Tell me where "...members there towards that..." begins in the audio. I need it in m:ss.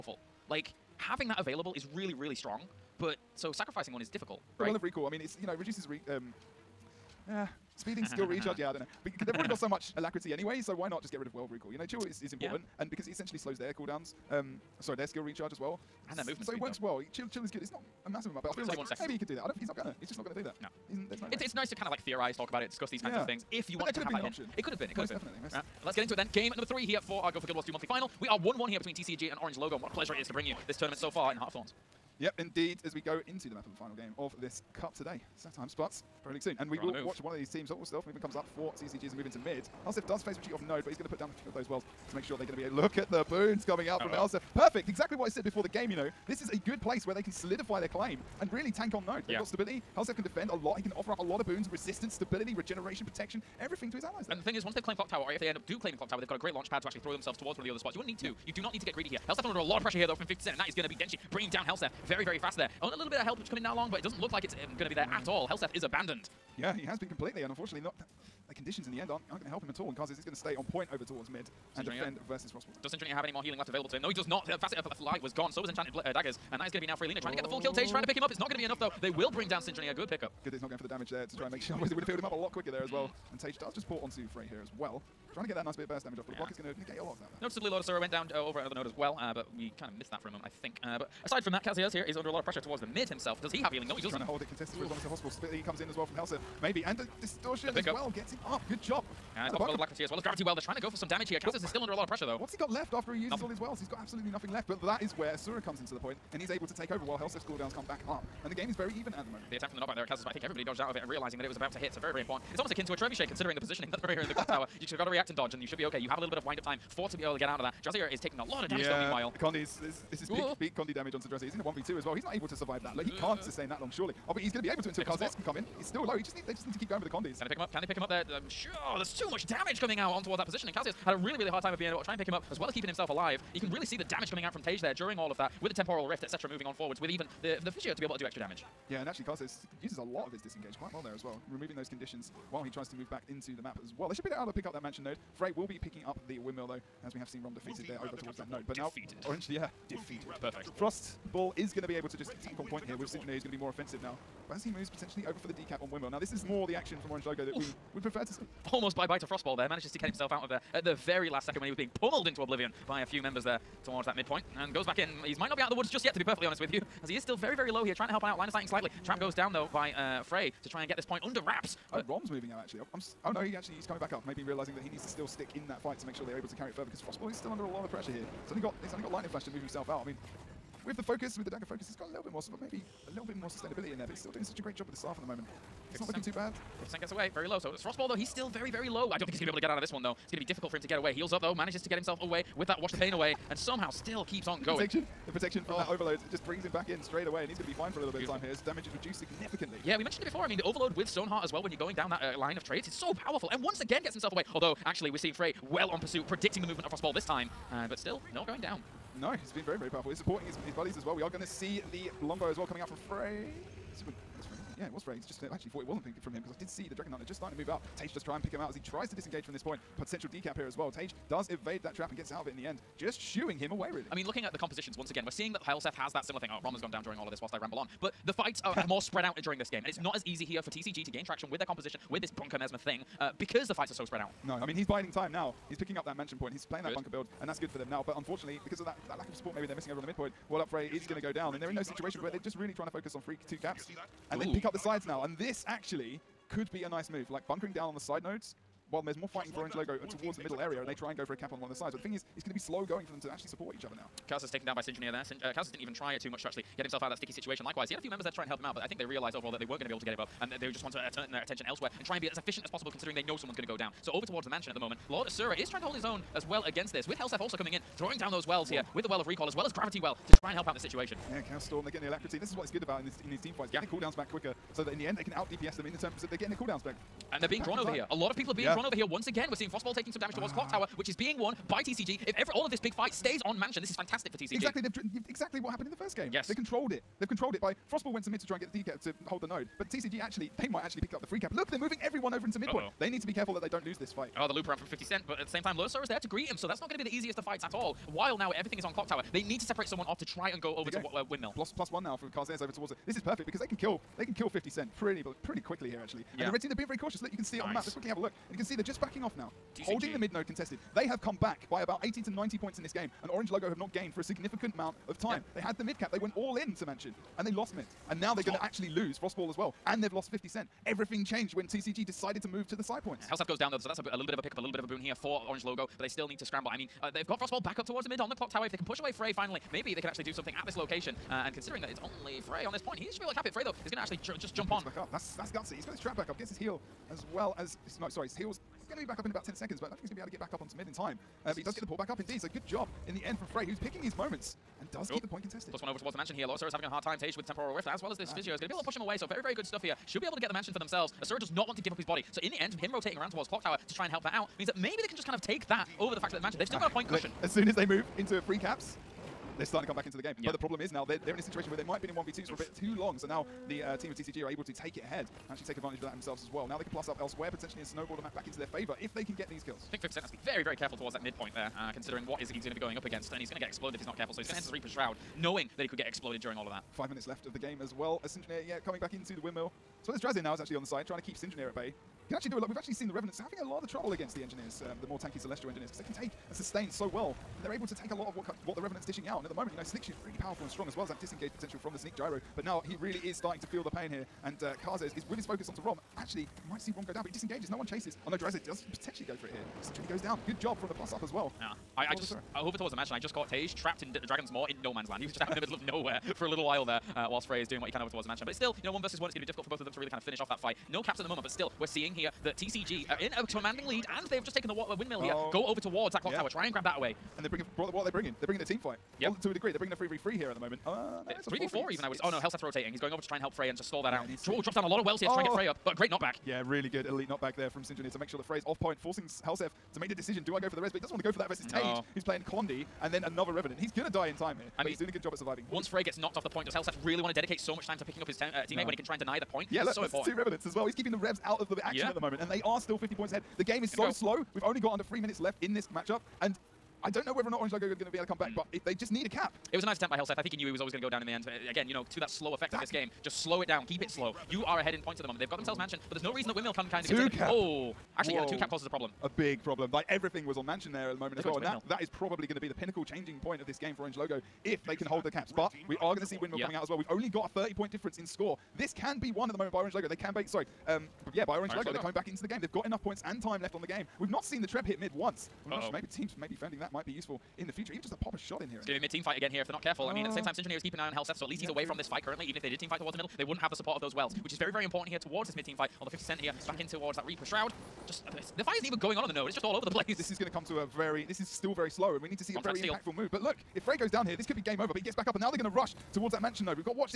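2:43.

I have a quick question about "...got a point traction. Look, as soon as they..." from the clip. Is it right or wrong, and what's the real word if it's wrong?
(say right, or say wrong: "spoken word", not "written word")
wrong: "cushion", not "traction".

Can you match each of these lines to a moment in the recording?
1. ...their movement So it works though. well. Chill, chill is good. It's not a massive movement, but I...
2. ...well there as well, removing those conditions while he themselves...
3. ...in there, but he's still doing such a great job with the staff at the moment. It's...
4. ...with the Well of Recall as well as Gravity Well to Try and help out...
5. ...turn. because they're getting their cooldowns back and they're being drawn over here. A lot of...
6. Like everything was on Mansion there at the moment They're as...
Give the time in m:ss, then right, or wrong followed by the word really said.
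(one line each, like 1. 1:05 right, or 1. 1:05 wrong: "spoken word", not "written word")
1. 0:16 wrong: "amount", not "movement"
2. 2:20 wrong: "tries", not "themselves"
3. 3:03 right
4. 4:28 right
5. 4:35 right
6. 7:39 right.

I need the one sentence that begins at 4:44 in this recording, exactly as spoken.
Exactly, they've exactly what happened in the first game.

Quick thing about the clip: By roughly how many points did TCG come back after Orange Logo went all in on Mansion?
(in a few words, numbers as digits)
80 to 90.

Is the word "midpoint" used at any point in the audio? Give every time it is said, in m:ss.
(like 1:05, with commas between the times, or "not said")
2:44, 4:00, 4:52, 6:11.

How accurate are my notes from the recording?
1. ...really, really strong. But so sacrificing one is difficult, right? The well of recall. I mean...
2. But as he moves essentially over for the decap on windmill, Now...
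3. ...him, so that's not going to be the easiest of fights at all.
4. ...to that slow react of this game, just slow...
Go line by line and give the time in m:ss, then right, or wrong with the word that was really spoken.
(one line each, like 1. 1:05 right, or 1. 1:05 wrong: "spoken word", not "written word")
1. 0:01 right
2. 2:34 wrong: "potentially", not "essentially"
3. 4:56 right
4. 7:32 wrong: "effect", not "react".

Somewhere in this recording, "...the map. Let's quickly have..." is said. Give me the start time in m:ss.
5:07.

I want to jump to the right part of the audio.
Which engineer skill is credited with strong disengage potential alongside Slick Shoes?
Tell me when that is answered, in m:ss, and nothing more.
6:31.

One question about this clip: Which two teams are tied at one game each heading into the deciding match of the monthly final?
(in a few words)
TCG and Orange Logo.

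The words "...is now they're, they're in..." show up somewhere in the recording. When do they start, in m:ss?
6:00.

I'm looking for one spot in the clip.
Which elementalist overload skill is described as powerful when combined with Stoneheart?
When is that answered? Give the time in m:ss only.
3:12.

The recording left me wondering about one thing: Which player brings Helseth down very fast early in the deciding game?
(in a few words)
Denshi.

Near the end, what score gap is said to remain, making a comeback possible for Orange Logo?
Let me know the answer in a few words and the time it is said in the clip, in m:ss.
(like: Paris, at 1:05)
30 points, at 7:47.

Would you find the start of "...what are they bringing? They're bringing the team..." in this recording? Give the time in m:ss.
6:57.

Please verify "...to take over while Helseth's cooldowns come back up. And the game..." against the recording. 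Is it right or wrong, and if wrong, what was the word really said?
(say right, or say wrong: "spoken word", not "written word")
right.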